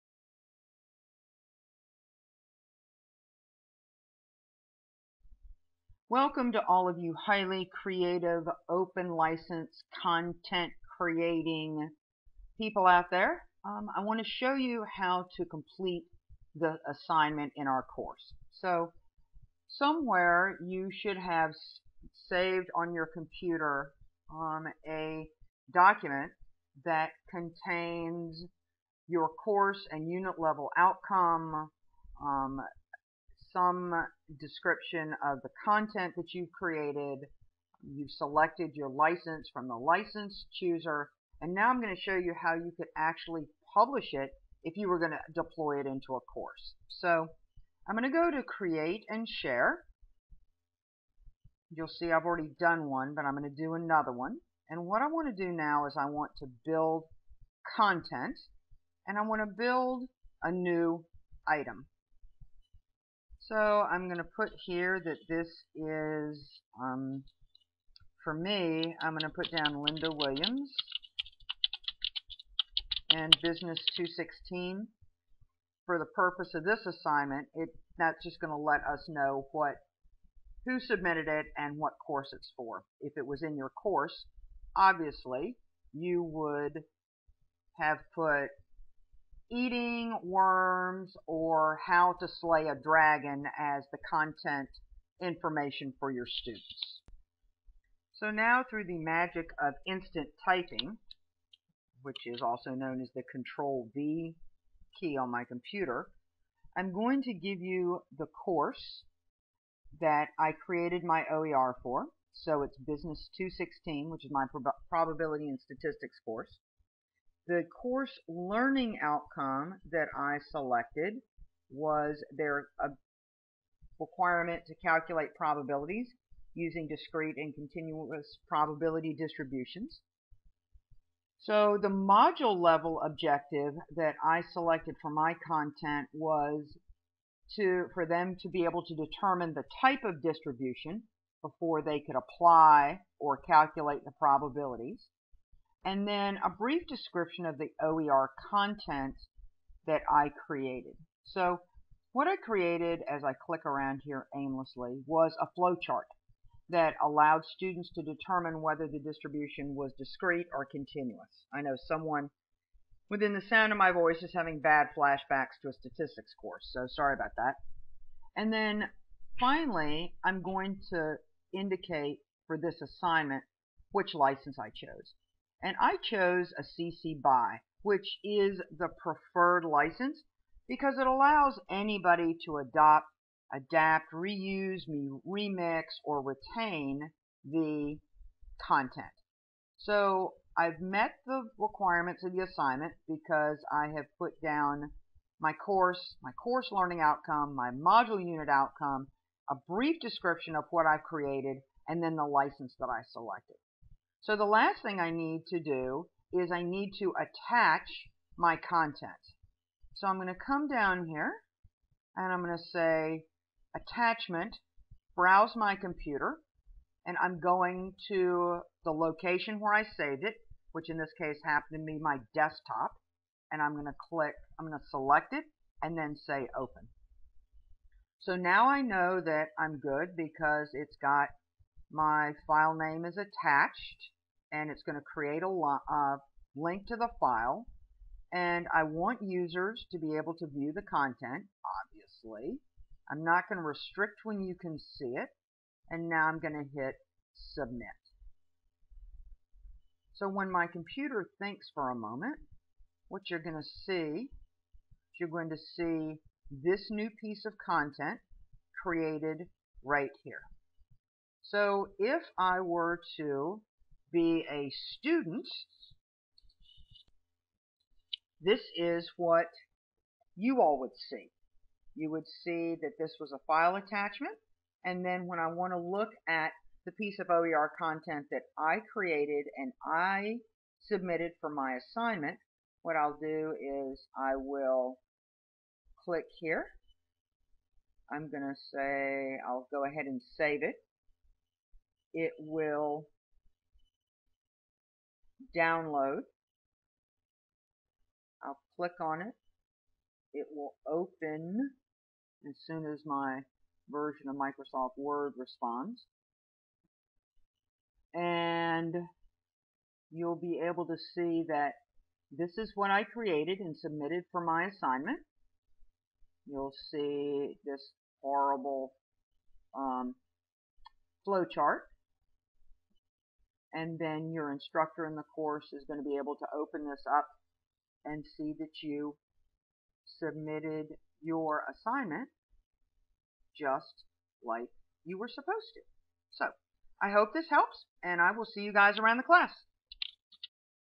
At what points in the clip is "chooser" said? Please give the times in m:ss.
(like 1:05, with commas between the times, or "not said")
0:40.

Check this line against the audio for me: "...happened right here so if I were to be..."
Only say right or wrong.
wrong.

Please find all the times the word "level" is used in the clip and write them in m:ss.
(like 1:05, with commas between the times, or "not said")
0:30, 2:12.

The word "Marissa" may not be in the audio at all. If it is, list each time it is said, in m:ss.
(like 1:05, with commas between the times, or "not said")
not said.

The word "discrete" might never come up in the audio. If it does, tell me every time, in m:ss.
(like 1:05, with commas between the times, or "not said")
2:06, 2:39.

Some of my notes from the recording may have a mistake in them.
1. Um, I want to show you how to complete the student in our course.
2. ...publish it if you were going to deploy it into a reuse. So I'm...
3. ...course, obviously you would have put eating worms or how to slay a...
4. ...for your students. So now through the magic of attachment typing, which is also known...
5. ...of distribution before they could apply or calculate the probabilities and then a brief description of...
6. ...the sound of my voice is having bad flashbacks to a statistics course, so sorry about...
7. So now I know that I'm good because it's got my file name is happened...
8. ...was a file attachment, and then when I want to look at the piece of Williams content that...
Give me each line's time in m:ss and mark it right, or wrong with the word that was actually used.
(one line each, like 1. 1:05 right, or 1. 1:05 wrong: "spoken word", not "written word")
1. 0:13 wrong: "assignment", not "student"
2. 0:43 wrong: "course", not "reuse"
3. 1:23 right
4. 1:35 wrong: "instant", not "attachment"
5. 2:20 right
6. 2:43 right
7. 3:48 wrong: "attached", not "happened"
8. 4:33 wrong: "OER", not "Williams".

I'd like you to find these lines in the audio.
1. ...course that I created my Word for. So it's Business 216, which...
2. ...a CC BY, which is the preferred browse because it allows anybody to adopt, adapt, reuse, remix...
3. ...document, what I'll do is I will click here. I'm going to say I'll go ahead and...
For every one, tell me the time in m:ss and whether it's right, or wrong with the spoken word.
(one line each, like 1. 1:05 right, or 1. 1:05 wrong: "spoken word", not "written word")
1. 1:48 wrong: "OER", not "Word"
2. 2:56 wrong: "license", not "browse"
3. 4:41 wrong: "assignment", not "document".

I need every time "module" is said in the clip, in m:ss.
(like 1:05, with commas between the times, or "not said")
2:11, 3:17.